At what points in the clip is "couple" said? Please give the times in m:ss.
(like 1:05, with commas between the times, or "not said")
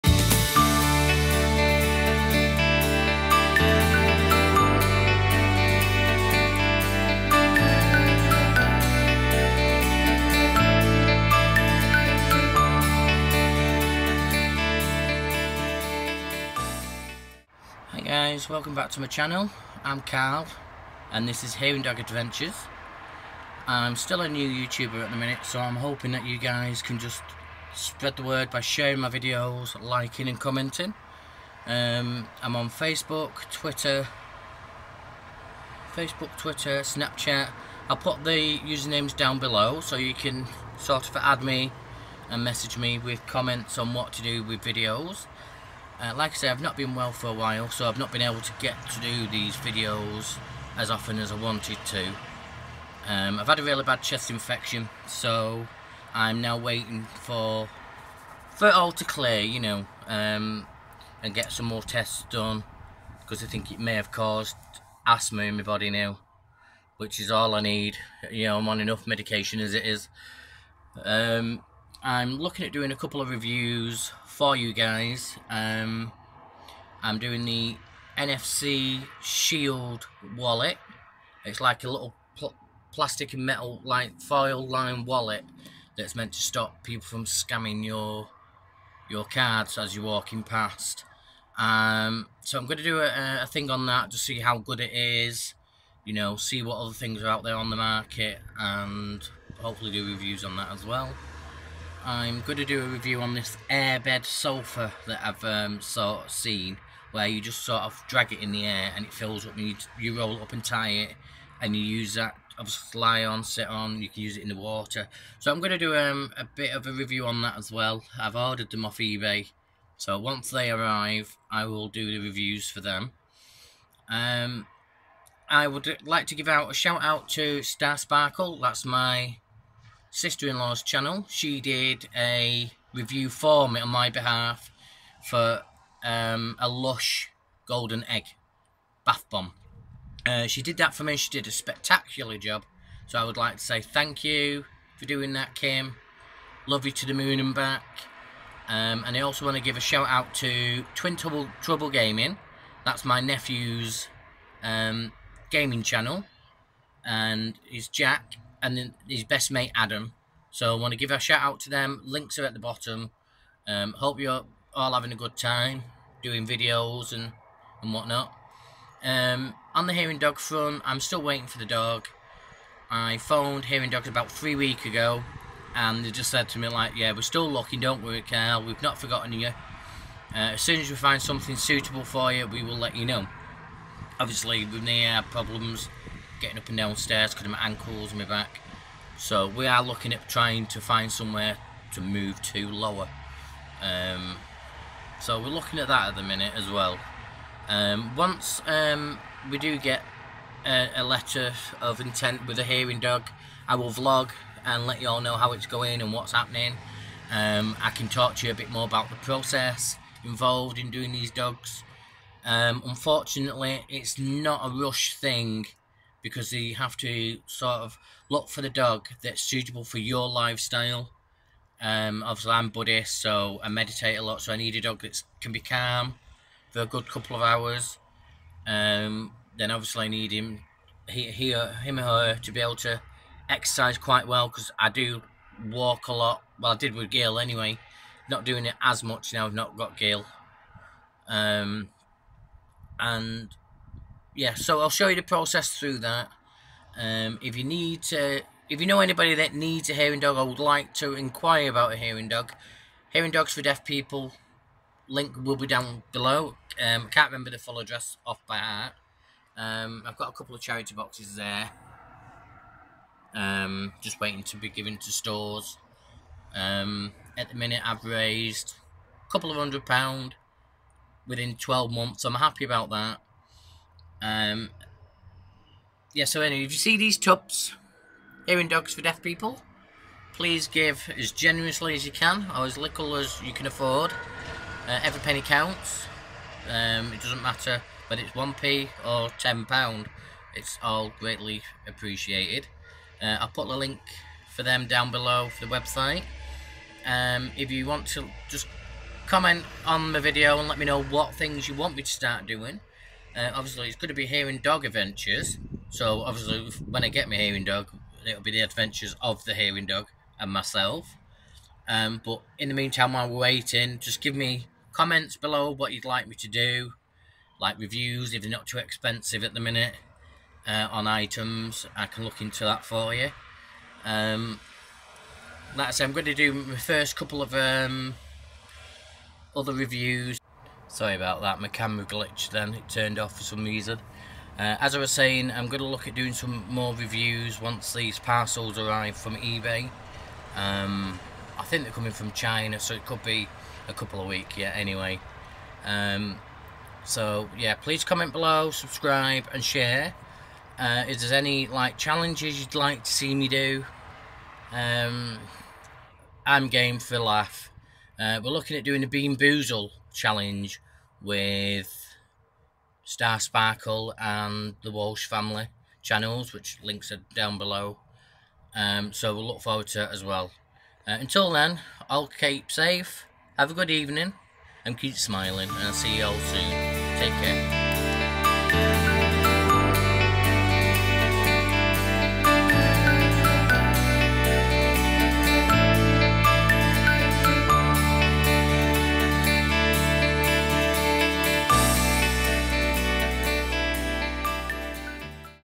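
1:12, 3:47, 4:20, 4:29, 5:27, 5:43.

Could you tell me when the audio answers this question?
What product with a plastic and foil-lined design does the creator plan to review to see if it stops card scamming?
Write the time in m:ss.
1:18.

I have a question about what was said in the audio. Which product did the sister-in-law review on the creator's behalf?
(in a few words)
Lush Golden Egg bath bomb.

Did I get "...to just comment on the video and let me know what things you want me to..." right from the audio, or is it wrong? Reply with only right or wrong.
right.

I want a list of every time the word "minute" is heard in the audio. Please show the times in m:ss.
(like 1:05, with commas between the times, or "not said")
0:25, 3:16, 4:27, 5:19.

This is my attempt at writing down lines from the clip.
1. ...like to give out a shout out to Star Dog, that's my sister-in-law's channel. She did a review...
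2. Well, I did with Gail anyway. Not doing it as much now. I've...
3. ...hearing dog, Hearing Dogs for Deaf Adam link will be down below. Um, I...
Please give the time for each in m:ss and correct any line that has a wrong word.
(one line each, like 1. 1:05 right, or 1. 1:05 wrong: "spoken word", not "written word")
1. 2:06 wrong: "Sparkle", not "Dog"
2. 3:56 right
3. 4:11 wrong: "People", not "Adam".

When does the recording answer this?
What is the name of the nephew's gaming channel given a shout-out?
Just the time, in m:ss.
2:30.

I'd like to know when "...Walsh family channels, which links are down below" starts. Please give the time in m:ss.
6:04.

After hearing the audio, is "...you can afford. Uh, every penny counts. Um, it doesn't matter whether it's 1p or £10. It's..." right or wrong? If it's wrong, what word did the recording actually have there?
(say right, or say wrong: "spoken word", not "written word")
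right.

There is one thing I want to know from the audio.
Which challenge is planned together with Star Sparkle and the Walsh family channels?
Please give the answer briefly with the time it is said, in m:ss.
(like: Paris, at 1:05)
Bean Boozle challenge, at 5:59.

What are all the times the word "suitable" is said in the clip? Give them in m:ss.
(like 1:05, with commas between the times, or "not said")
3:01, 3:39.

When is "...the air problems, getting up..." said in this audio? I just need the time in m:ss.
3:04.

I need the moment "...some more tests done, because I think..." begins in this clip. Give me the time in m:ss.
1:01.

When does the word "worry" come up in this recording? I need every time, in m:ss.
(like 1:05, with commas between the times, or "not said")
2:58.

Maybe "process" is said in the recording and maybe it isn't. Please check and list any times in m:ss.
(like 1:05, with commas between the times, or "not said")
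3:29, 4:05.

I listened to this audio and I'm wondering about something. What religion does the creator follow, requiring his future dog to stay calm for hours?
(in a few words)
Buddhist.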